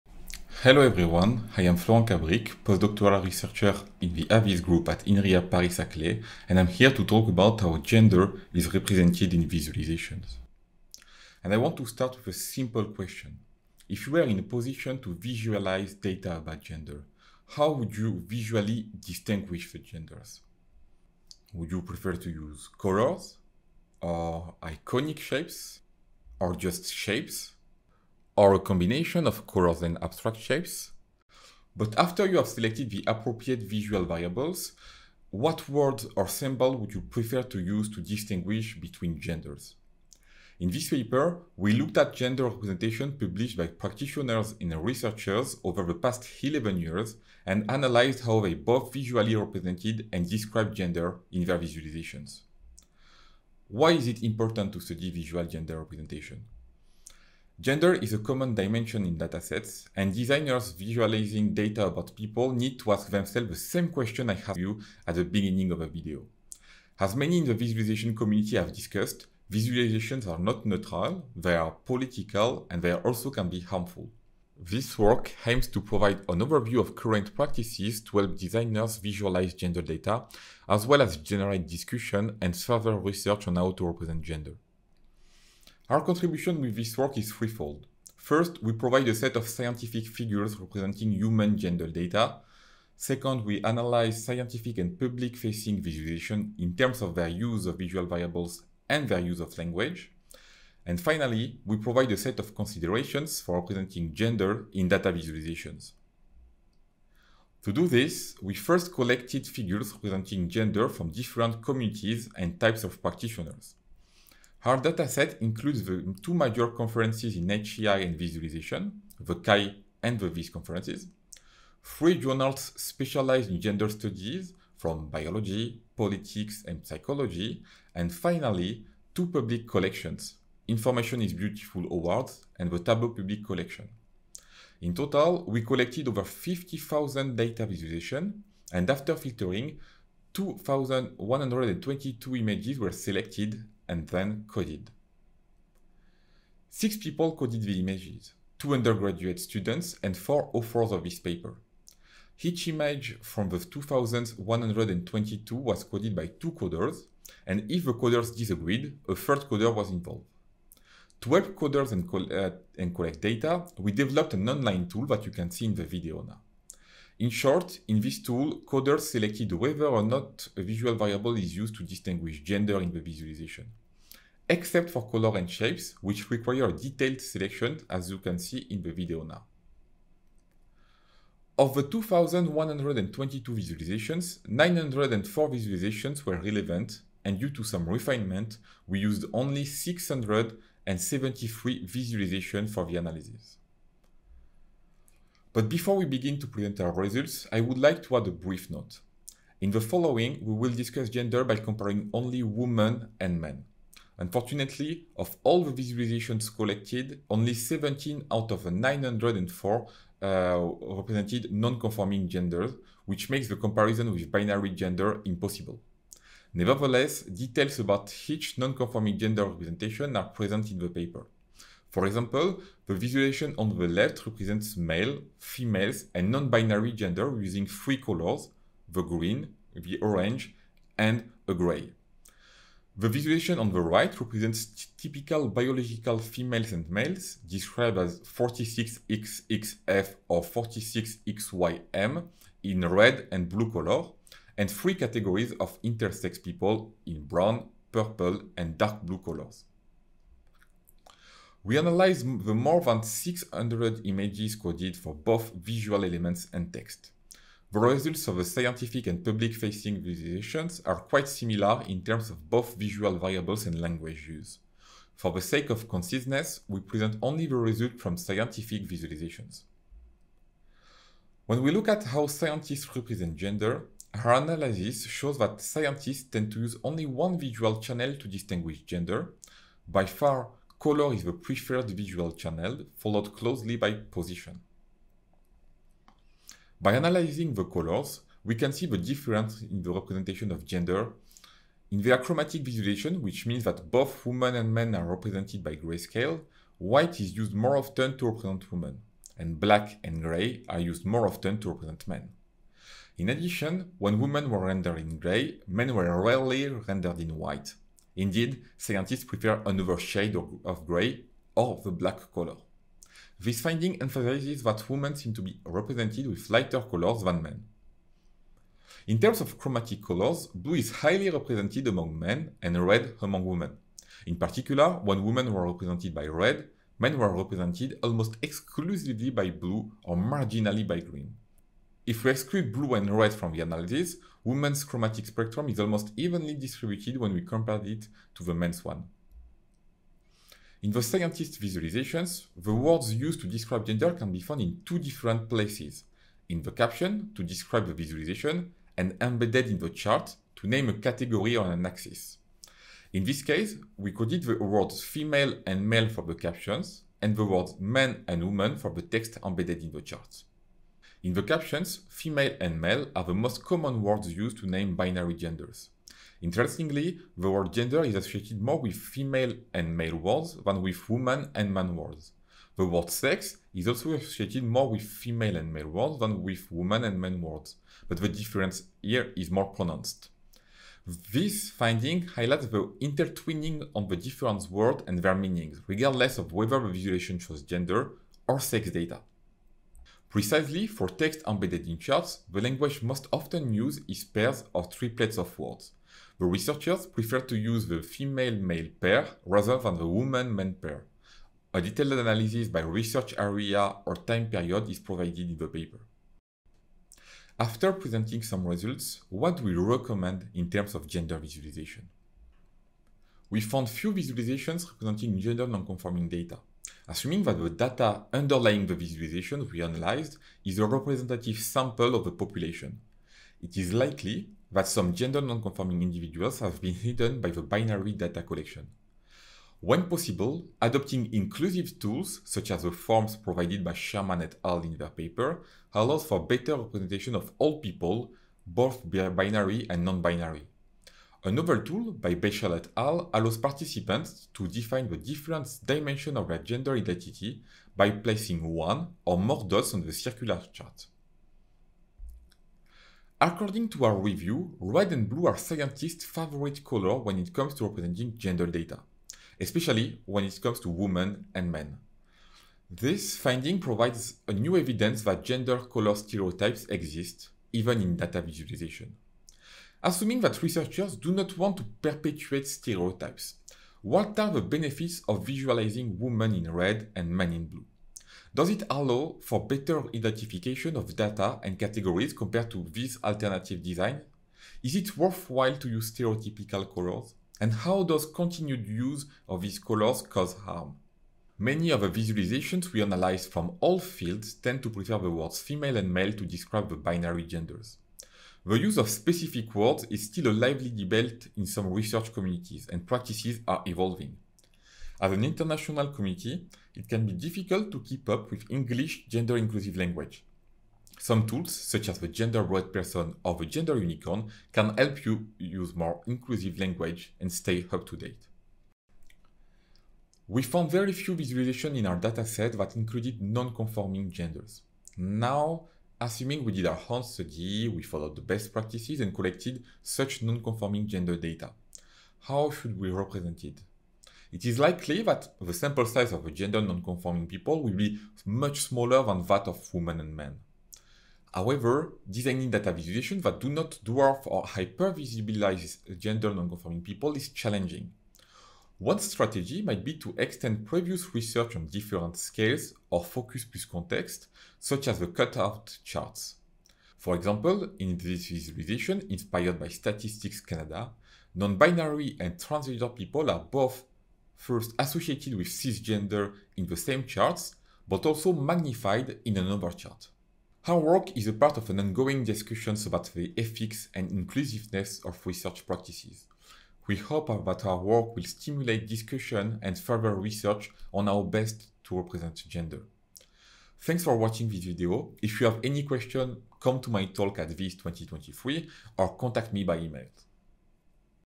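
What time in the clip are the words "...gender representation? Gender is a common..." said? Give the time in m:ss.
0:55.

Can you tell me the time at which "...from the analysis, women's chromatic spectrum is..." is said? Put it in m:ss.
5:33.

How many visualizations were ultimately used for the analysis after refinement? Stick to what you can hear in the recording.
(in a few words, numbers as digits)
673.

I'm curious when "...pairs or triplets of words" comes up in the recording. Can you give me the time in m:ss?
6:34.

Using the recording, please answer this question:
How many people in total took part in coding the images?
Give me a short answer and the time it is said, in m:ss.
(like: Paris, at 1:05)
Six, at 2:26.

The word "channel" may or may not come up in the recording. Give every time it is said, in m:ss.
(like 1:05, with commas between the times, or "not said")
4:37, 4:42.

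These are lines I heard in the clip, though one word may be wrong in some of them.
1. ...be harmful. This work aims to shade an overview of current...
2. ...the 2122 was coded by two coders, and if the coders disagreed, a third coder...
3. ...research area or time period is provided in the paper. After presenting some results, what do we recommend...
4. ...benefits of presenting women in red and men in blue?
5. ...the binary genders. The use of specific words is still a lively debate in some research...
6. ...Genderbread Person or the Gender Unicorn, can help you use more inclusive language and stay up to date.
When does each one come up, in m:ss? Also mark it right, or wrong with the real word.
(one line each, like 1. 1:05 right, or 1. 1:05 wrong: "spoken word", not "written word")
1. 1:13 wrong: "provide", not "shade"
2. 2:33 right
3. 6:42 right
4. 7:54 wrong: "visualizing", not "presenting"
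5. 8:16 right
6. 8:32 right.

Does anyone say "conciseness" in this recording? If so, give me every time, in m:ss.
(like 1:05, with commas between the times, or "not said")
4:25.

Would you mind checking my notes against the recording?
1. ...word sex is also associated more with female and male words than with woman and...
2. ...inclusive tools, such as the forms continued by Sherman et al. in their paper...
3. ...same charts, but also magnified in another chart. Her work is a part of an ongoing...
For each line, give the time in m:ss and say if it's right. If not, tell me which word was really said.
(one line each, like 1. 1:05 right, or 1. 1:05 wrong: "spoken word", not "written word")
1. 6:12 right
2. 7:11 wrong: "provided", not "continued"
3. 9:26 right.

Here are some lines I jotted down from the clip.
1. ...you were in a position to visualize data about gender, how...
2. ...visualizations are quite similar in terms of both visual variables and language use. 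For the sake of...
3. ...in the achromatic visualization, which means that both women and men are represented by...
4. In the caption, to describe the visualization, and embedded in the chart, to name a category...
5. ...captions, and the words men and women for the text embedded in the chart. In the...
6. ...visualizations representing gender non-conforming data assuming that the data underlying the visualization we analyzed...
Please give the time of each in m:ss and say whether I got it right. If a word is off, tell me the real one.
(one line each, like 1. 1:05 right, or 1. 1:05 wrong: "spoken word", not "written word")
1. 0:14 right
2. 4:20 right
3. 4:51 right
4. 5:46 right
5. 5:56 right
6. 6:54 right.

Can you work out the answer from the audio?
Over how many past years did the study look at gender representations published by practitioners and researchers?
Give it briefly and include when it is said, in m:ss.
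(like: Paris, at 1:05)
11, at 0:46.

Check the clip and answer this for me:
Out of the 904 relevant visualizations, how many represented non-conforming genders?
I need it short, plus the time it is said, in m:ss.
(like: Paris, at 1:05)
17, at 3:27.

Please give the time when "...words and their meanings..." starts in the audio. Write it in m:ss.
6:24.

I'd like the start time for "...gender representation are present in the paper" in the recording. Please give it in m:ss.
3:39.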